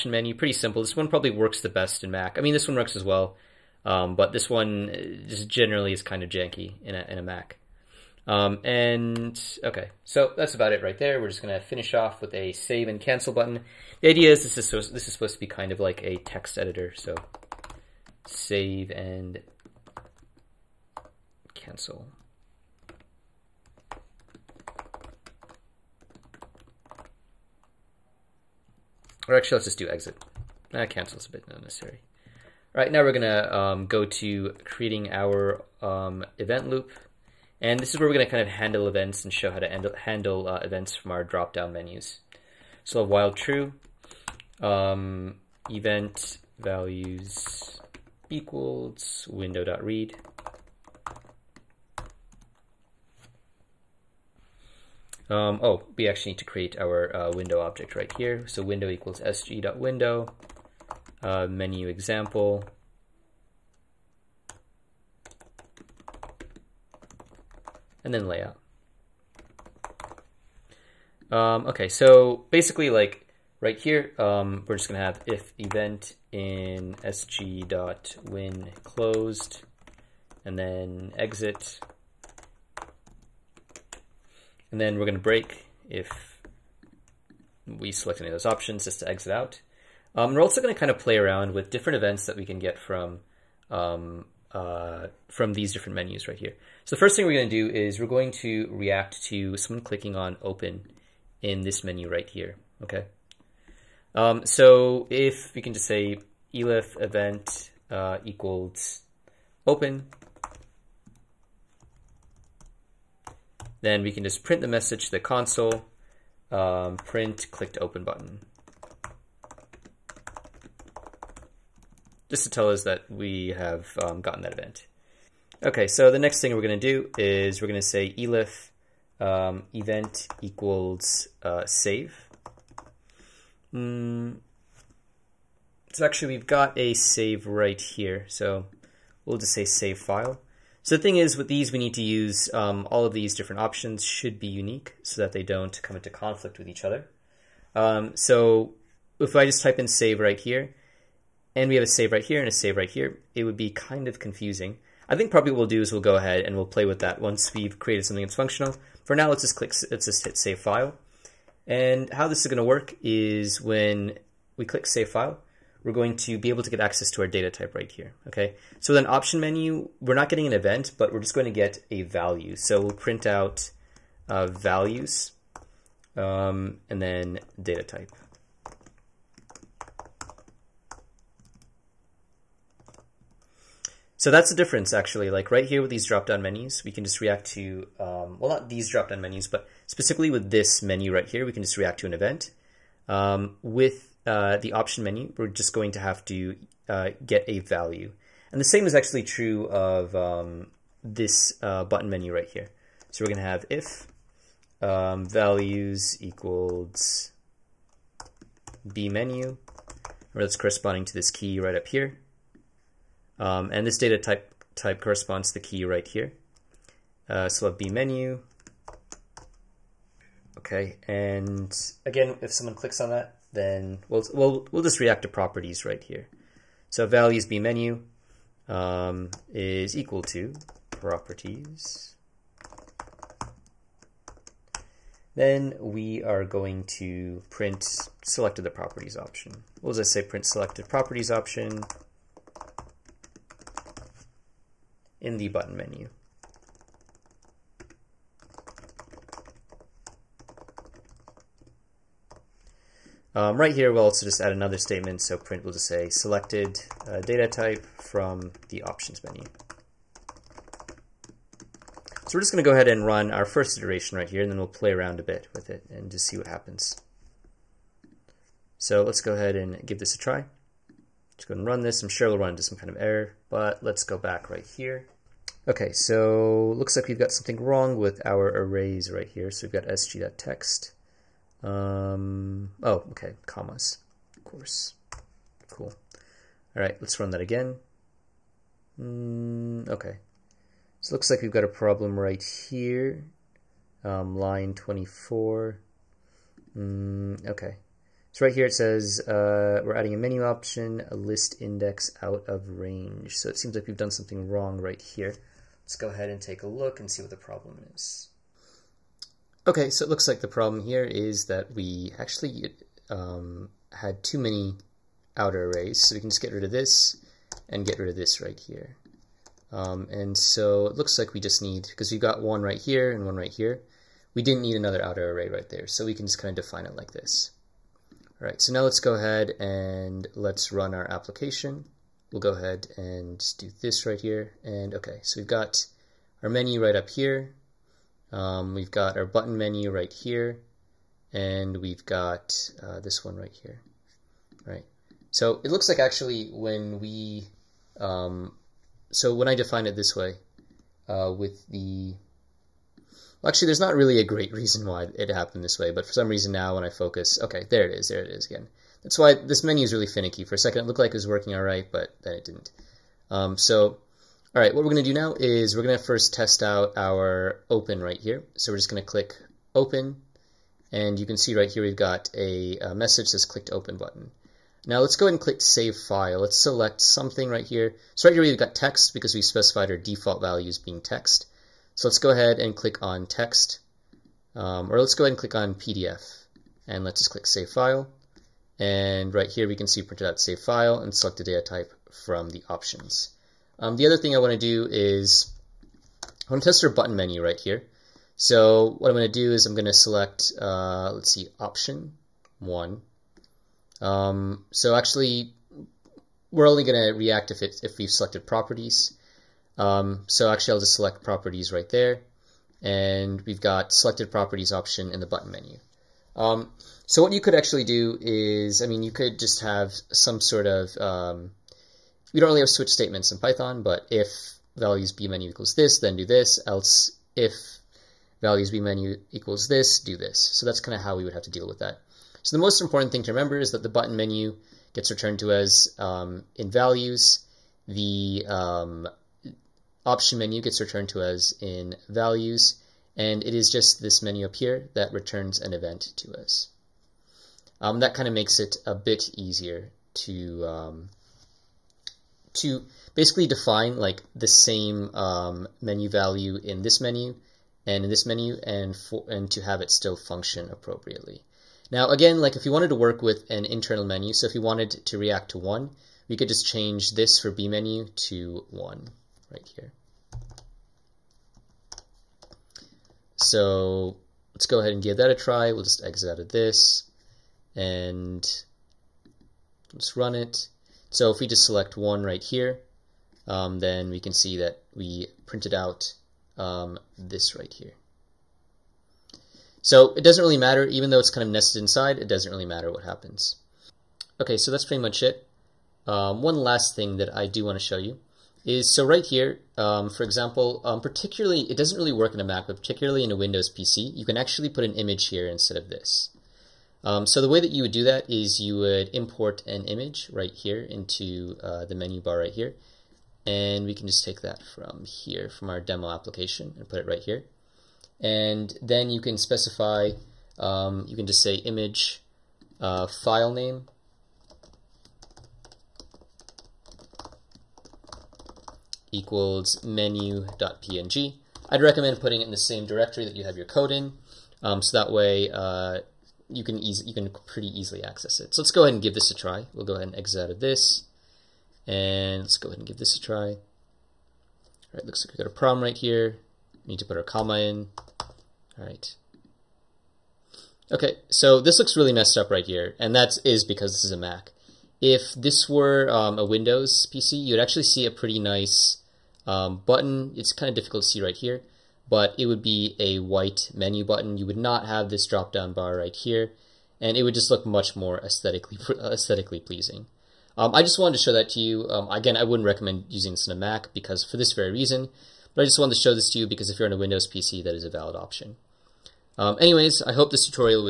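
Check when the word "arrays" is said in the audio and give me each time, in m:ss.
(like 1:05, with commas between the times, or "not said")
4:38, 5:15, 5:25.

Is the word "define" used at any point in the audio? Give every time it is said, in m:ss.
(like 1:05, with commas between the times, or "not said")
5:26, 5:49, 7:33.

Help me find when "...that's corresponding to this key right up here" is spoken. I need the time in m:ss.
3:30.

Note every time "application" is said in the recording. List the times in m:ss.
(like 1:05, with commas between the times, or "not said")
5:31, 8:36.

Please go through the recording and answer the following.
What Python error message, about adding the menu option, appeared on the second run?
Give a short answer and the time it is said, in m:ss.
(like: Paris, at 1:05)
list index out of range, at 5:01.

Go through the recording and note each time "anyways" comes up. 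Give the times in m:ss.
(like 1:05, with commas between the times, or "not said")
9:39.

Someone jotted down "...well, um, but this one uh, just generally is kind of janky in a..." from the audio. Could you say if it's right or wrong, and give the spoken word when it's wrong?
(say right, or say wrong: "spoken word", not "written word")
right.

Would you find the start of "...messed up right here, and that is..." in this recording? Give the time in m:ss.
9:12.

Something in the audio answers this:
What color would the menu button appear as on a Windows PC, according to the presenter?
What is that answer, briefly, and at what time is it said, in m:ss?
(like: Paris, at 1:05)
white, at 9:23.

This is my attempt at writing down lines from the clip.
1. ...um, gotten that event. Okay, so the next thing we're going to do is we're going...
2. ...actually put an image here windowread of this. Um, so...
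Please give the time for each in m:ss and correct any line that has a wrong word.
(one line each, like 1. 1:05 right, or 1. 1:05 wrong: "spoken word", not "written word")
1. 2:04 right
2. 8:24 wrong: "instead", not "windowread".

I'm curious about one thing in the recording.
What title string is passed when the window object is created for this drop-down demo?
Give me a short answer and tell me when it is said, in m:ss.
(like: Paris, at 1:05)
menu example, at 1:01.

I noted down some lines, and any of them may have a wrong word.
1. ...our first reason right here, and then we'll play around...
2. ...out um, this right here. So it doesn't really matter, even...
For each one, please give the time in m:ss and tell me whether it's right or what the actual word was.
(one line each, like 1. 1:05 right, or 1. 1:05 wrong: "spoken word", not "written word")
1. 4:23 wrong: "iteration", not "reason"
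2. 8:05 right.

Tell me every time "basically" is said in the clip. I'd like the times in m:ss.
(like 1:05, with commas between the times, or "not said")
1:12, 7:33.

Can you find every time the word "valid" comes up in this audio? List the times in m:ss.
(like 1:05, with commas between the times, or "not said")
9:37.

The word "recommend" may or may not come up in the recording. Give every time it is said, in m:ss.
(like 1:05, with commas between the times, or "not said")
8:51, 9:32.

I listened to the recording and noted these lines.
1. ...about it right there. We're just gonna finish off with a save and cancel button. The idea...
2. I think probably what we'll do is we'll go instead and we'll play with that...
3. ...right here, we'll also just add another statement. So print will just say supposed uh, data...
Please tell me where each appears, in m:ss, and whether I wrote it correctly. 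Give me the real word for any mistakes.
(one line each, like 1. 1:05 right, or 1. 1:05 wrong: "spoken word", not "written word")
1. 0:10 right
2. 2:35 wrong: "ahead", not "instead"
3. 4:13 wrong: "selected", not "supposed".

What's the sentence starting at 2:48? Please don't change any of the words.
So with an option menu, we're not getting an event, but we're just going to get a value.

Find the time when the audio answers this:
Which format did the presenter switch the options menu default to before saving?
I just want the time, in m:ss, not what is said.
6:25.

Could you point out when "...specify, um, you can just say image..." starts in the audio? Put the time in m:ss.
8:39.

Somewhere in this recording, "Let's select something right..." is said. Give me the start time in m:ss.
6:16.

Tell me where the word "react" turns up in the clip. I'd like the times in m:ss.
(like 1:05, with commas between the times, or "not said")
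1:38, 3:07, 3:11, 3:45, 6:47, 7:45.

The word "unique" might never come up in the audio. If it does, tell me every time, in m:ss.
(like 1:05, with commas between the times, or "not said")
2:24.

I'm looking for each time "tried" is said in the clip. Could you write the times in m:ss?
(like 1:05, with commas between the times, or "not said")
not said.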